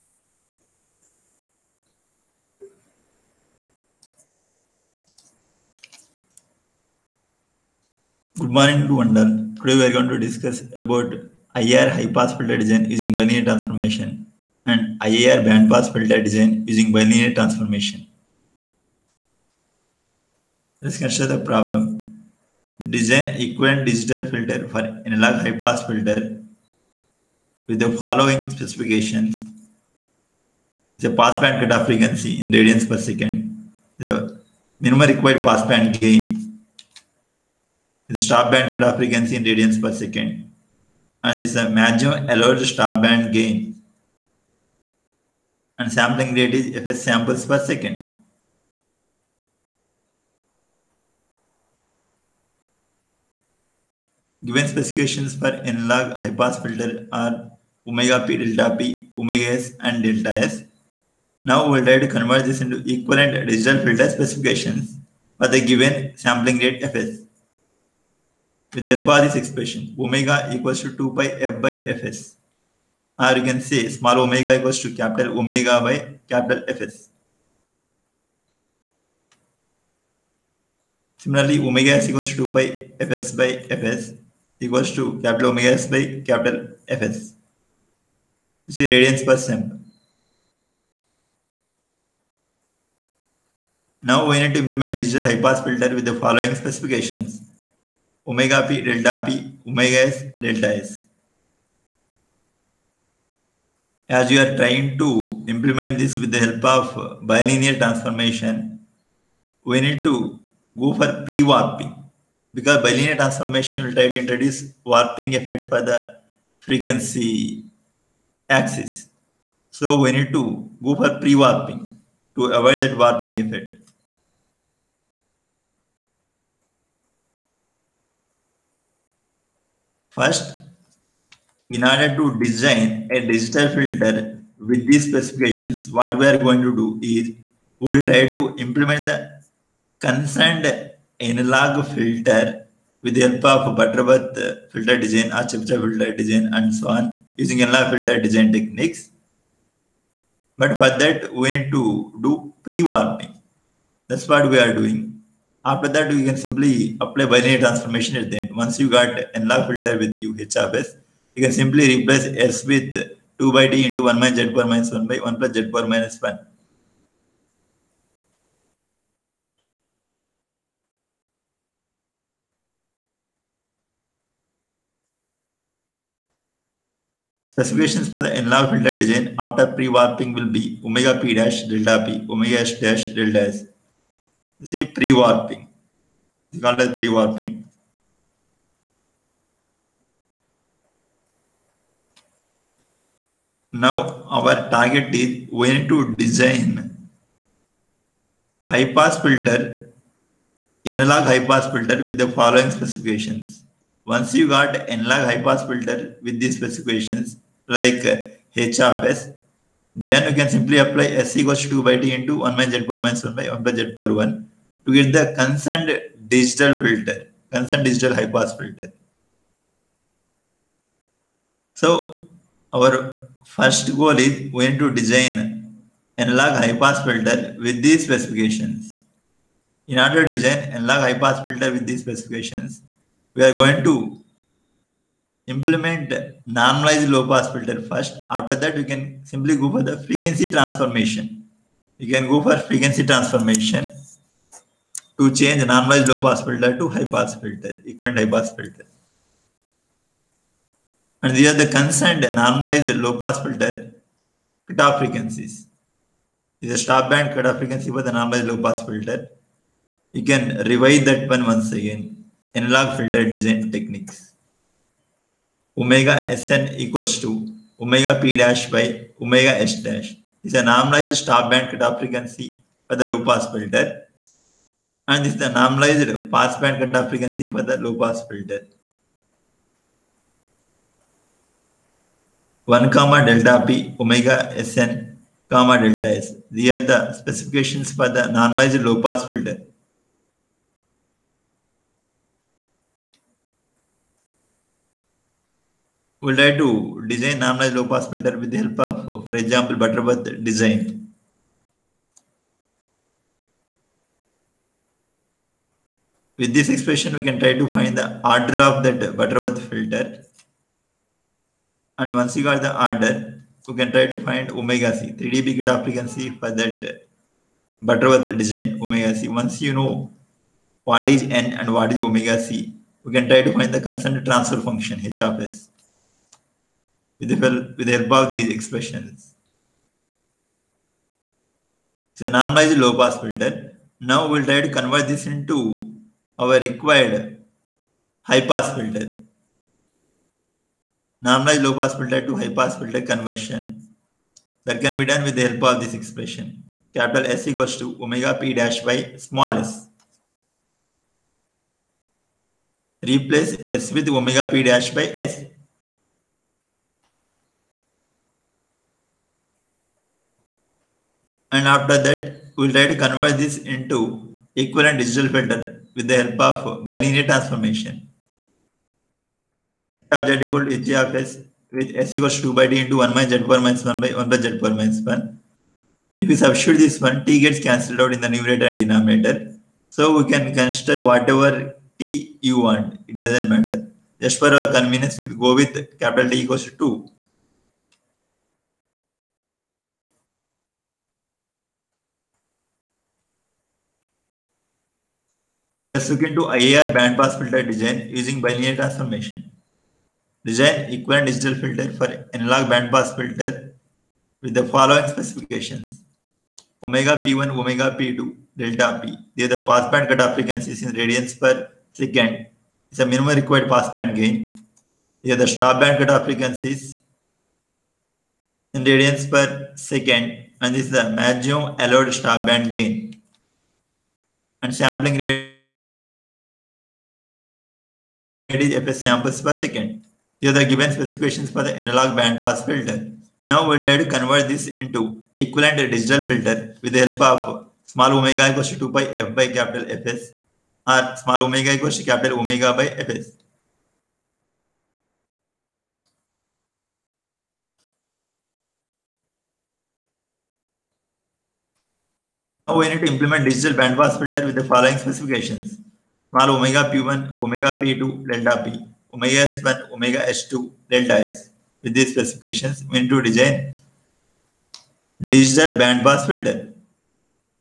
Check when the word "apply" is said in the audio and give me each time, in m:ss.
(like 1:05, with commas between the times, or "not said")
2:37, 3:30.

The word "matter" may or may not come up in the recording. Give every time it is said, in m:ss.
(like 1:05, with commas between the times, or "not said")
6:23.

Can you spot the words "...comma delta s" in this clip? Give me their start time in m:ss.
4:45.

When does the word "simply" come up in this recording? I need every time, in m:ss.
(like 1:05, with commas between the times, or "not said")
2:36, 2:41, 3:30, 3:59.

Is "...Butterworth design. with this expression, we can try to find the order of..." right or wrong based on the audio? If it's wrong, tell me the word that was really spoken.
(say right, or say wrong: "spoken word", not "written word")
right.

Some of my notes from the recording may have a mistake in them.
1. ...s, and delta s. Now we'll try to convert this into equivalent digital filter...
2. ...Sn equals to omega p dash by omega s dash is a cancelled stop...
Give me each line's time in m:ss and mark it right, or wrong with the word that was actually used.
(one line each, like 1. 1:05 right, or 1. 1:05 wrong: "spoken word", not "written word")
1. 0:59 right
2. 4:26 wrong: "normalized", not "cancelled".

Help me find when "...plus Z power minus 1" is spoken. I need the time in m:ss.
2:45.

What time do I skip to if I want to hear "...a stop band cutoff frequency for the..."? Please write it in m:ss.
4:16.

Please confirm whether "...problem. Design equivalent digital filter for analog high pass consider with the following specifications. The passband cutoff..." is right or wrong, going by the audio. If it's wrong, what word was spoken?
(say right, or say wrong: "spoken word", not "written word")
wrong: "filter", not "consider".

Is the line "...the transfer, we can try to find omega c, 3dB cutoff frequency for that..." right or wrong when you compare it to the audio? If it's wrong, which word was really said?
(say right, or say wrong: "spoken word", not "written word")
wrong: "order", not "transfer".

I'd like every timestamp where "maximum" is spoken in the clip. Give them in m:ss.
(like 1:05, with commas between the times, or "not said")
0:41, 7:01.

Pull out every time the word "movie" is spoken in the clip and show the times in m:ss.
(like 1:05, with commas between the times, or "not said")
not said.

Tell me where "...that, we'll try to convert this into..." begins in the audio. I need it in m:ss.
6:02.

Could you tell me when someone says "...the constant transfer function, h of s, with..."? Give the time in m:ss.
5:23.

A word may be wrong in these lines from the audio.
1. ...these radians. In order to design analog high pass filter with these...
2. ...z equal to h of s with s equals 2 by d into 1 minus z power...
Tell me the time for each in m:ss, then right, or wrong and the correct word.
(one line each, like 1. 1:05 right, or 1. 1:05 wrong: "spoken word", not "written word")
1. 3:47 wrong: "specifications", not "radians"
2. 6:10 right.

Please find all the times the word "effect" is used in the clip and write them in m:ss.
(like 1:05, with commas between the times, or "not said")
1:55, 2:03.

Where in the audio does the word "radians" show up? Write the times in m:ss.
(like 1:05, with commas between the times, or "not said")
0:32, 0:39, 1:28, 6:50, 6:58.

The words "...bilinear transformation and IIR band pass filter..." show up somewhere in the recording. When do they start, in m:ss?
0:13.